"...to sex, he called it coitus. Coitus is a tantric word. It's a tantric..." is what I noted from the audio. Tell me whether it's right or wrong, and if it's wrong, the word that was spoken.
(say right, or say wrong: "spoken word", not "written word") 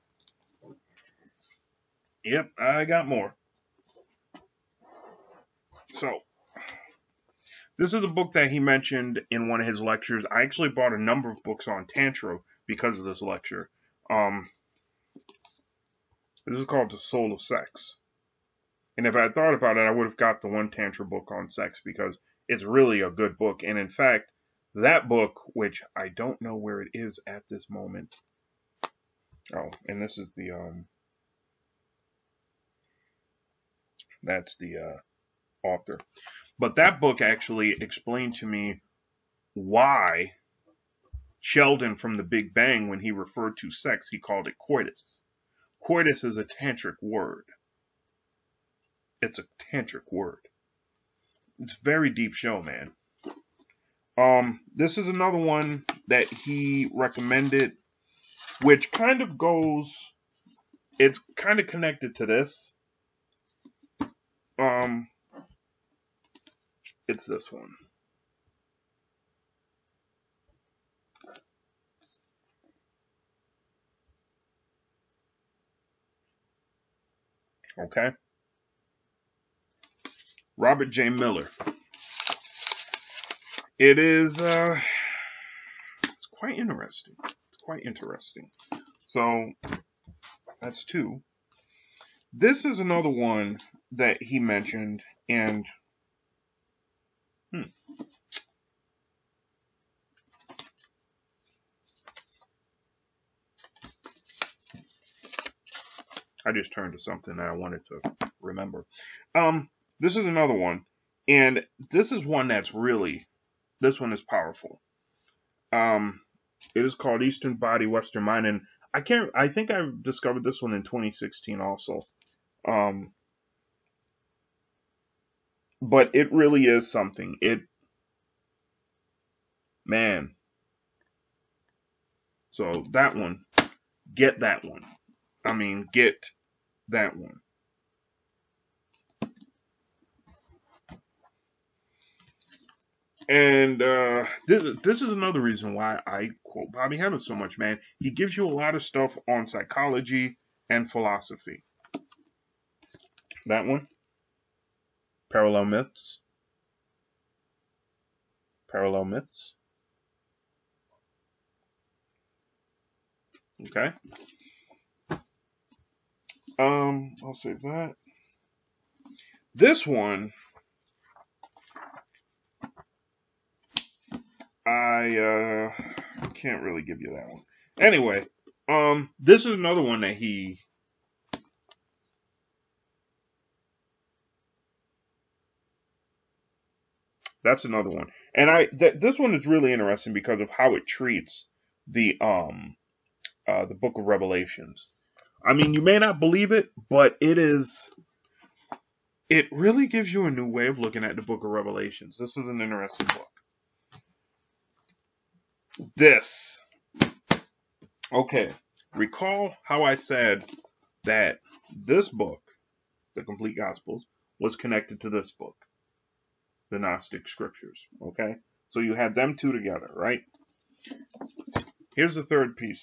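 right.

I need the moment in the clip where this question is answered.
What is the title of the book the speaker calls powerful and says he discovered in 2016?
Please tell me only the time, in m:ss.
1:57.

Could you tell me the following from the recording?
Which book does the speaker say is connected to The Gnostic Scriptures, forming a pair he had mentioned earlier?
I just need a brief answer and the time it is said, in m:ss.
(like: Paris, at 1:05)
The Complete Gospels, at 3:33.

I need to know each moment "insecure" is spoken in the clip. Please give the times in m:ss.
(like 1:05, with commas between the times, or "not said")
not said.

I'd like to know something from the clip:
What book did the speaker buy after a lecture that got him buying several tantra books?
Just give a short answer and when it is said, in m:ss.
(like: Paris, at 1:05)
The Soul of Sex, at 0:16.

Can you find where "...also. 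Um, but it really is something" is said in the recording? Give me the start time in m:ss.
2:01.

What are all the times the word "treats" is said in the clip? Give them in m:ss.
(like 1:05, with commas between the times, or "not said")
3:10.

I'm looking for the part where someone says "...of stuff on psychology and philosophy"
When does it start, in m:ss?
2:28.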